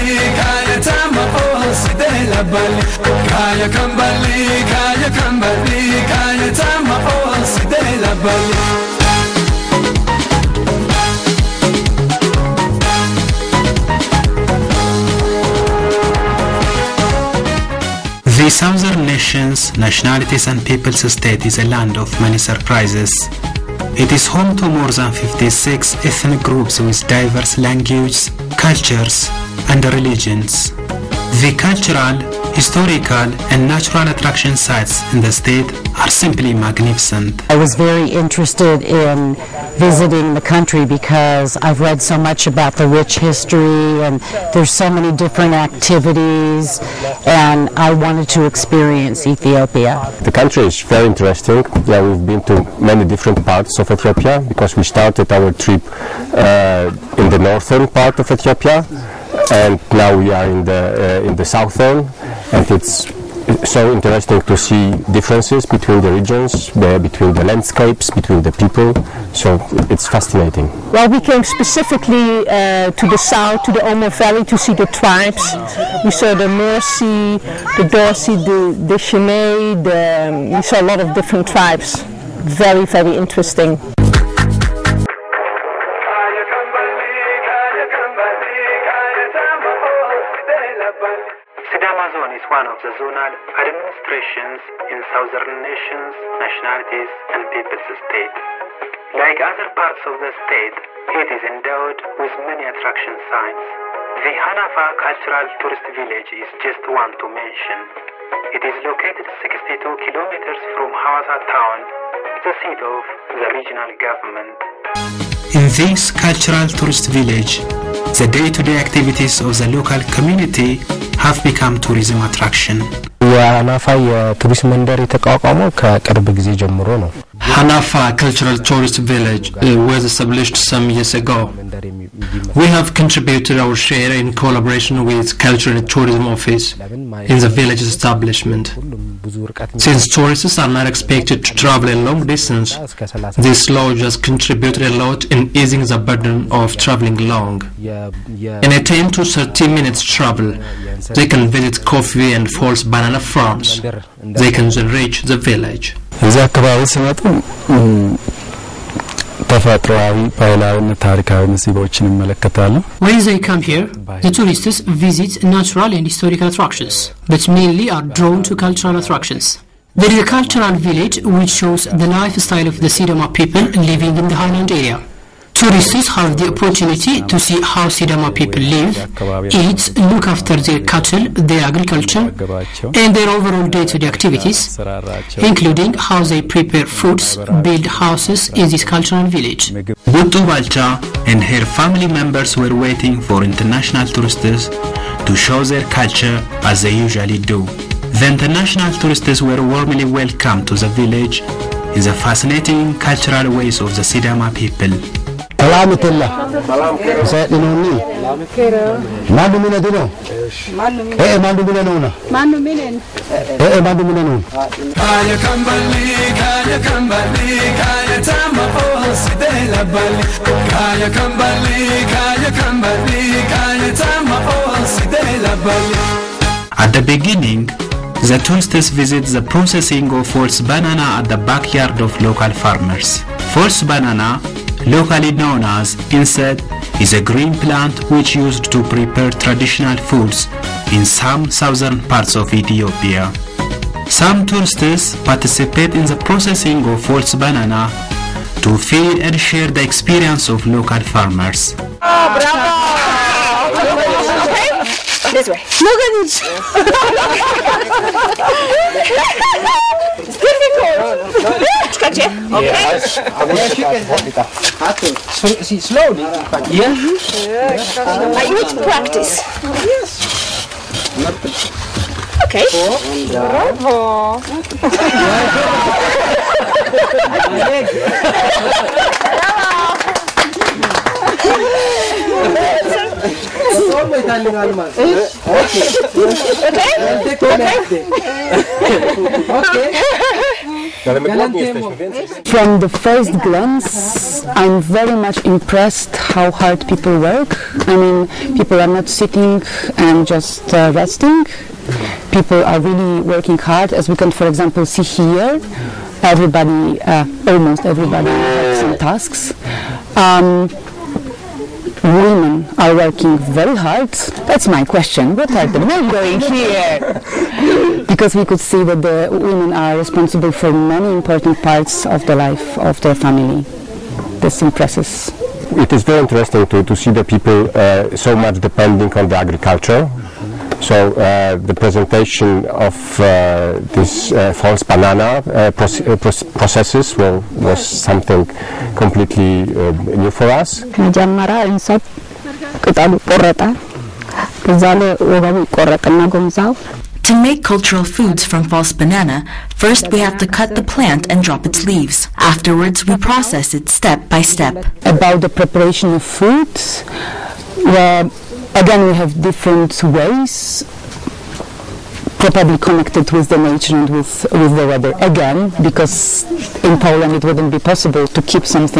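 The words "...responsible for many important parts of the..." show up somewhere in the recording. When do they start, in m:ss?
5:19.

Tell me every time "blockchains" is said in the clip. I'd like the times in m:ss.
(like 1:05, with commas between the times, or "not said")
not said.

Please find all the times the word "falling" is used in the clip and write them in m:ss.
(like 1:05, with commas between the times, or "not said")
not said.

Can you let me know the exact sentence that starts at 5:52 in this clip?
Afterwards, we process it step by step.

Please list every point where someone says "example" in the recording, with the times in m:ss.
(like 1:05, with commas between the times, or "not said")
5:04.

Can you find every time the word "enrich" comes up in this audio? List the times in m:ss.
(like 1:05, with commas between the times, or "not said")
2:34.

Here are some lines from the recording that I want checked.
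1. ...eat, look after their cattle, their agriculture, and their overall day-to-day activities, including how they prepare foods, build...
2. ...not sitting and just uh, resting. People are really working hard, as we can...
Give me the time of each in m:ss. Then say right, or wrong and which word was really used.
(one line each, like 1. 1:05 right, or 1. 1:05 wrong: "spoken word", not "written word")
1. 2:59 right
2. 4:58 right.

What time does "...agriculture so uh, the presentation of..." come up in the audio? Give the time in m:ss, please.
5:29.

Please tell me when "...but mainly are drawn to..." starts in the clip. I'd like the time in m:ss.
2:47.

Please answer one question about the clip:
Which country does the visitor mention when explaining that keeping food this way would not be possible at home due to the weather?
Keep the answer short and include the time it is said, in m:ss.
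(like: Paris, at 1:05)
Poland, at 6:06.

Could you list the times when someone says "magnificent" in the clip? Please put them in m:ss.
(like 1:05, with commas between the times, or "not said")
0:36.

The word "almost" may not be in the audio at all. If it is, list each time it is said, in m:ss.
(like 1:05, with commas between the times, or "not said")
5:07.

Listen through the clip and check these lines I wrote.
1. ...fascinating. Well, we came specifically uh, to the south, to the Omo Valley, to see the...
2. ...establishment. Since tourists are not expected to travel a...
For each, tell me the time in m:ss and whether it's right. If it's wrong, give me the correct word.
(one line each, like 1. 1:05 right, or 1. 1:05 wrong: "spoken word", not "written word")
1. 1:10 right
2. 2:17 right.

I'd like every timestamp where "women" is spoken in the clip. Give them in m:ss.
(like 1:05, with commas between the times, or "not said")
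5:12, 5:19.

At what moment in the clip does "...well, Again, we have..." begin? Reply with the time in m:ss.
5:57.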